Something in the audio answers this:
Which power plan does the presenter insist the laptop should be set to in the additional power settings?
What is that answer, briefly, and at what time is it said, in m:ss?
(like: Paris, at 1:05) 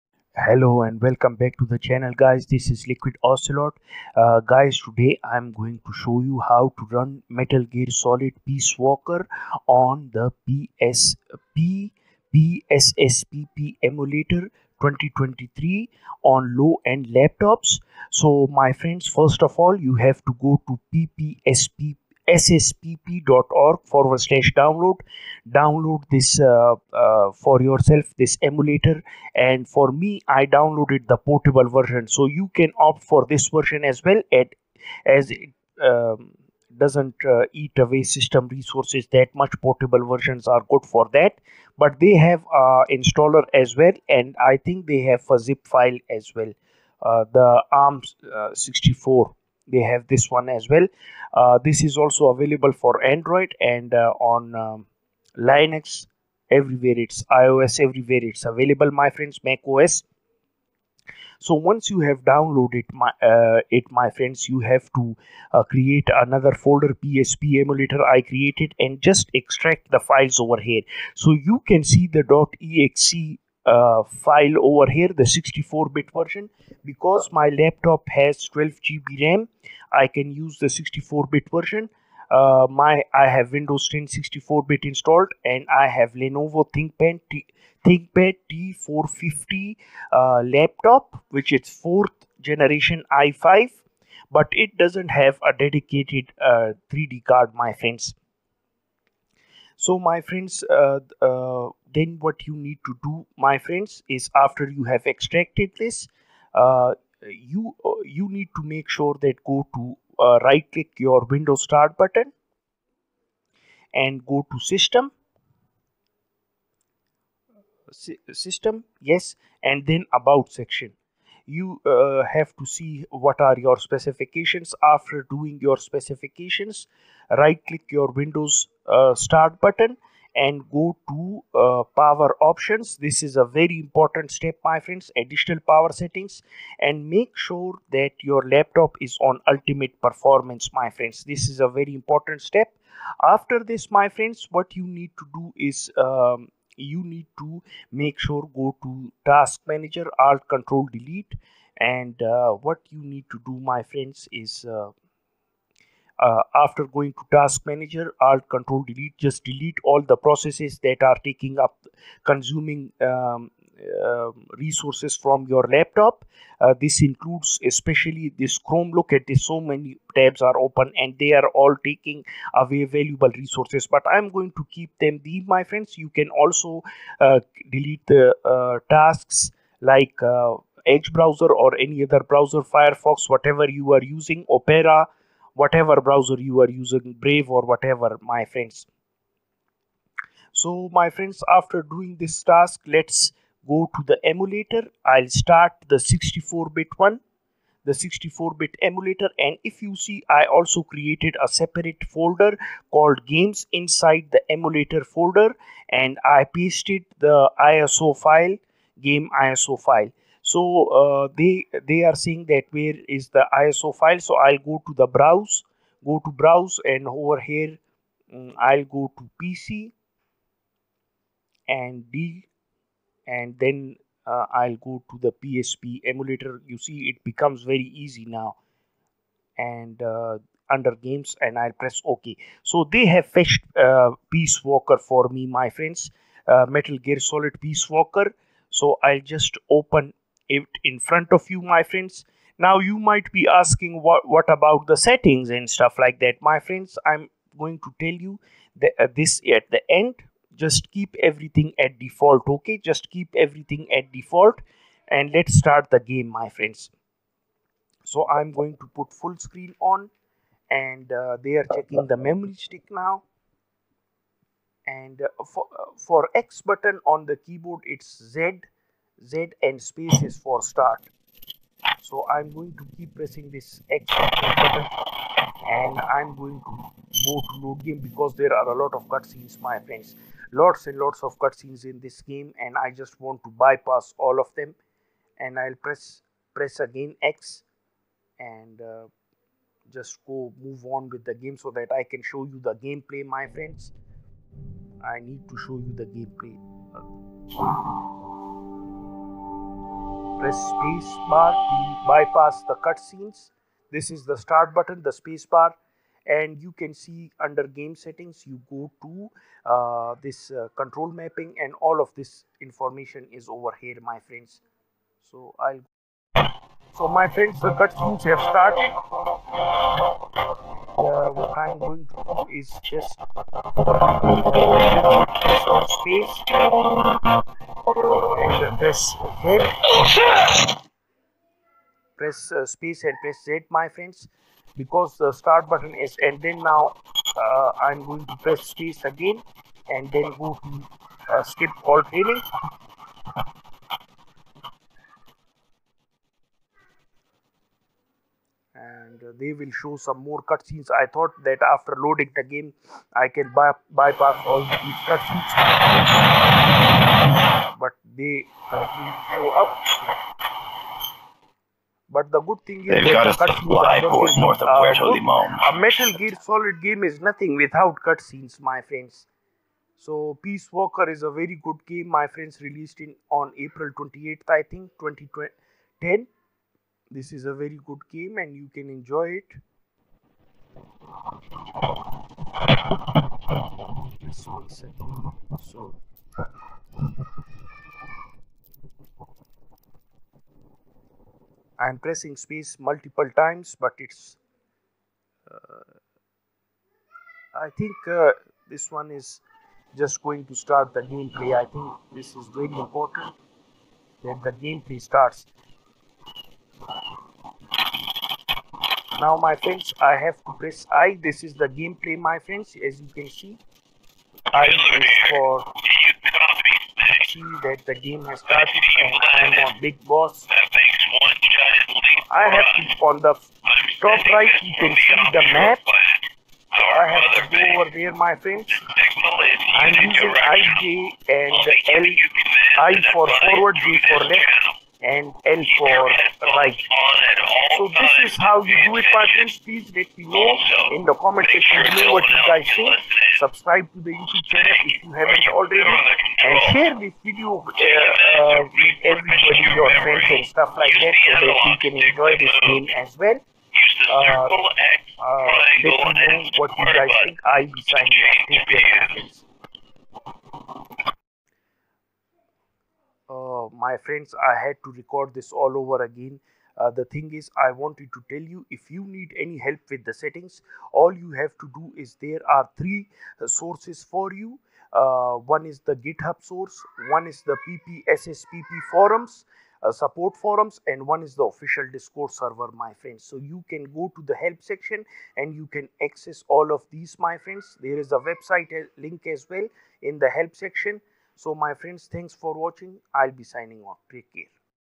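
Ultimate performance, at 2:19.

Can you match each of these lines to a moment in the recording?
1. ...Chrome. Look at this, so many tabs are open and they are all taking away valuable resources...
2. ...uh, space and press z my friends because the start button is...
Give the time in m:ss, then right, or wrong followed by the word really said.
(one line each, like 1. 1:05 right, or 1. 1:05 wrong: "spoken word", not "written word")
1. 2:48 right
2. 5:32 right.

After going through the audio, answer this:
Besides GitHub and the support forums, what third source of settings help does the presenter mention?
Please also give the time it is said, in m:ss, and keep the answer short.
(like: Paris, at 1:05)
Official Discord server, at 8:01.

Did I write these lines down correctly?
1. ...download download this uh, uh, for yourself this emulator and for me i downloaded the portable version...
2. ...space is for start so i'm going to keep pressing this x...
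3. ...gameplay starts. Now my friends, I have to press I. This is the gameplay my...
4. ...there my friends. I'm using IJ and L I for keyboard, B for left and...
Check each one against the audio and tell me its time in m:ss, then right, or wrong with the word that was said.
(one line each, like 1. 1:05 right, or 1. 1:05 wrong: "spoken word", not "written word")
1. 0:24 right
2. 4:29 right
3. 6:44 right
4. 7:07 wrong: "forward", not "keyboard".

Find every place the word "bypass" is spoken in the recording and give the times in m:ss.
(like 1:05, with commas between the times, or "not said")
4:43, 5:02, 5:53.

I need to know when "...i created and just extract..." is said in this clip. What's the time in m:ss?
1:08.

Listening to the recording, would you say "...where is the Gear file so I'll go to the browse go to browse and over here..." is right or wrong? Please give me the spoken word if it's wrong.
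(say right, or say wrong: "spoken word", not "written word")
wrong: "ISO", not "Gear".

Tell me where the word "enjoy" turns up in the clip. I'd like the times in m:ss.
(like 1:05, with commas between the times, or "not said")
6:18, 7:31.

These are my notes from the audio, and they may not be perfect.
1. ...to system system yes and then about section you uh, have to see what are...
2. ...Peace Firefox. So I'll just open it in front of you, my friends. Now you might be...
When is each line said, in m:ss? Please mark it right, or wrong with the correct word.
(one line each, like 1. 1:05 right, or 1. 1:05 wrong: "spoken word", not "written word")
1. 1:54 right
2. 3:57 wrong: "Walker", not "Firefox".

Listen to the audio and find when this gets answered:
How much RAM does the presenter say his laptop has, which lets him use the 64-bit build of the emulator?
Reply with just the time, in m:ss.
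1:18.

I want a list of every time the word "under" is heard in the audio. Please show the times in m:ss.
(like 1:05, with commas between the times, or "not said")
3:50, 5:07.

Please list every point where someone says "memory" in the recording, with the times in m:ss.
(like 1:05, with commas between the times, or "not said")
4:22.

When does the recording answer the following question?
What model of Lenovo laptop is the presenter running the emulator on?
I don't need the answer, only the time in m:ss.
1:27.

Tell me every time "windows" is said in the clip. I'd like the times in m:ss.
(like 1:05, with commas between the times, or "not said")
1:23, 1:51, 2:08.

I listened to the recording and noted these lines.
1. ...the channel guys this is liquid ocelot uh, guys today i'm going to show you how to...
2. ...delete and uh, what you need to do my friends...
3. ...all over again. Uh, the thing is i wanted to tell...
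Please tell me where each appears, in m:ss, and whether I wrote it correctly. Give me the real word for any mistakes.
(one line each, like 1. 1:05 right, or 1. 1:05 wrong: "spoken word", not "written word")
1. 0:01 right
2. 2:30 right
3. 7:45 right.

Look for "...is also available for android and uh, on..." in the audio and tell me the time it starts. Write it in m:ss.
0:51.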